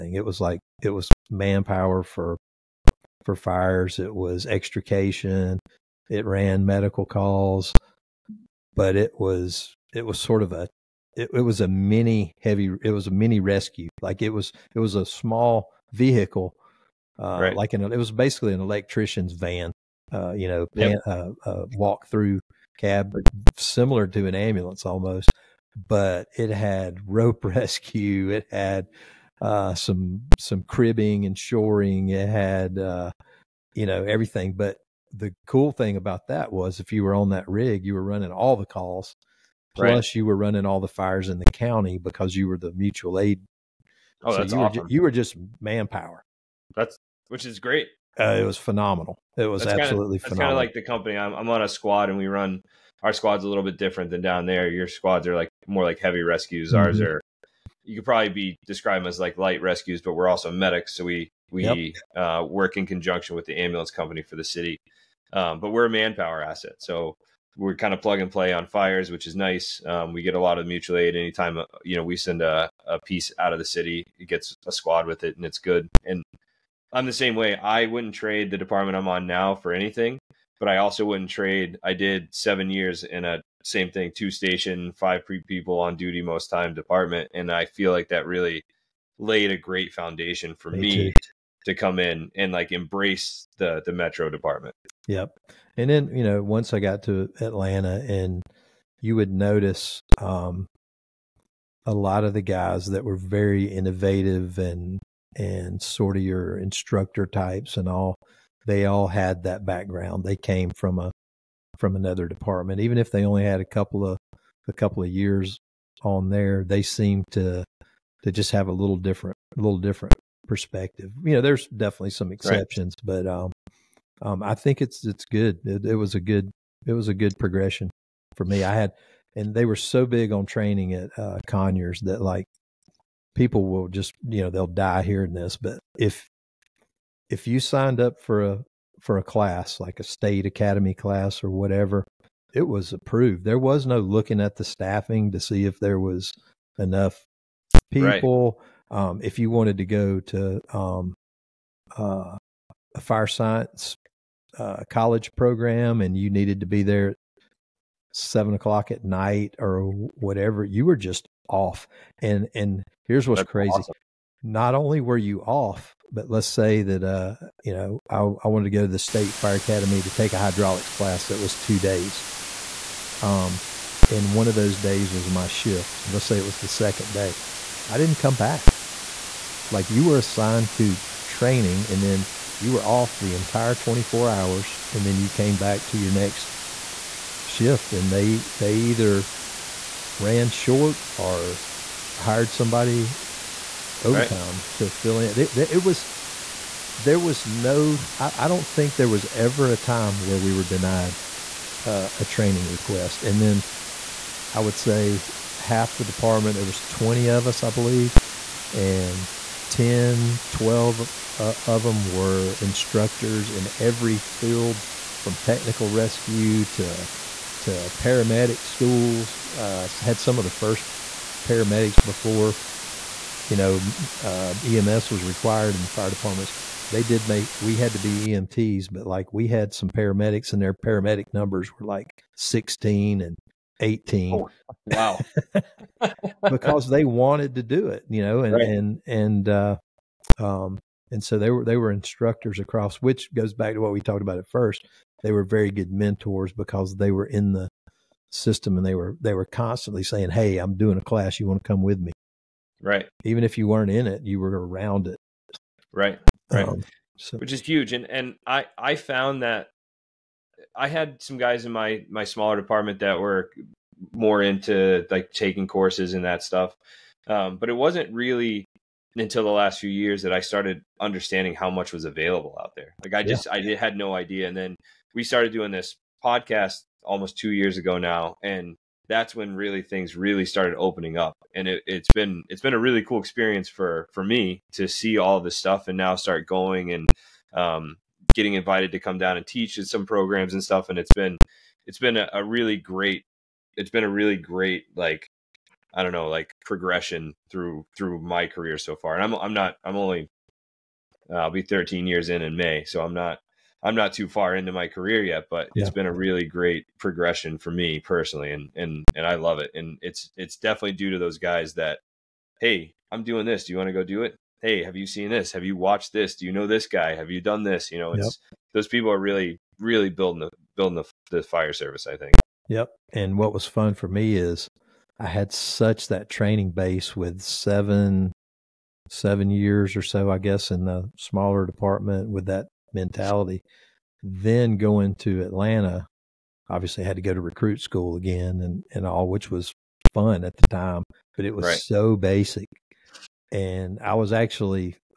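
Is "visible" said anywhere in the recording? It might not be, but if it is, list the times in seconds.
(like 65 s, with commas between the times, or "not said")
not said.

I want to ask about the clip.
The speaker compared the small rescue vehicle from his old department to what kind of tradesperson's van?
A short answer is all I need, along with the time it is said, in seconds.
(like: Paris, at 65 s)
electrician's van, at 18 s.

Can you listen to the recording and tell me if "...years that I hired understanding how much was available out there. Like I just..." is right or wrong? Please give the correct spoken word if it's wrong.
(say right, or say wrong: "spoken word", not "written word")
wrong: "started", not "hired".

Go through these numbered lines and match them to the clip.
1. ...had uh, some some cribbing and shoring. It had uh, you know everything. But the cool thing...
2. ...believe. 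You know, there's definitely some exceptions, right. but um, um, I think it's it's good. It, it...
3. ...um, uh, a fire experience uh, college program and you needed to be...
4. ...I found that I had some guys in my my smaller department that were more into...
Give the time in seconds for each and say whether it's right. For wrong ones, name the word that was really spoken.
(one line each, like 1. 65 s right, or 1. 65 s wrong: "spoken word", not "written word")
1. 28 s right
2. 120 s wrong: "perspective", not "believe"
3. 150 s wrong: "science", not "experience"
4. 258 s right.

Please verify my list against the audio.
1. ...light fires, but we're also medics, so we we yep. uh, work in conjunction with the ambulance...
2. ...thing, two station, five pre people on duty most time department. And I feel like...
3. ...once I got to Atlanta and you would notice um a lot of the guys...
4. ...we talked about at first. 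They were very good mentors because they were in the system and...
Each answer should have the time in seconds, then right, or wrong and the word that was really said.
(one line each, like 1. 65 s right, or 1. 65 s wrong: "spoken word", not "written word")
1. 59 s wrong: "rescues", not "fires"
2. 83 s right
3. 96 s right
4. 243 s right.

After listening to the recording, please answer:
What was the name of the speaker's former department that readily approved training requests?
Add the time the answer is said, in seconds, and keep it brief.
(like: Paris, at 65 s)
Conyers, at 131 s.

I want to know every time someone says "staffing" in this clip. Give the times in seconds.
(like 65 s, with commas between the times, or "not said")
144 s.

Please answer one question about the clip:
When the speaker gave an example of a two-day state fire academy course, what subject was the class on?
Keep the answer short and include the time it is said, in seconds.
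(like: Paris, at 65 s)
hydraulics, at 170 s.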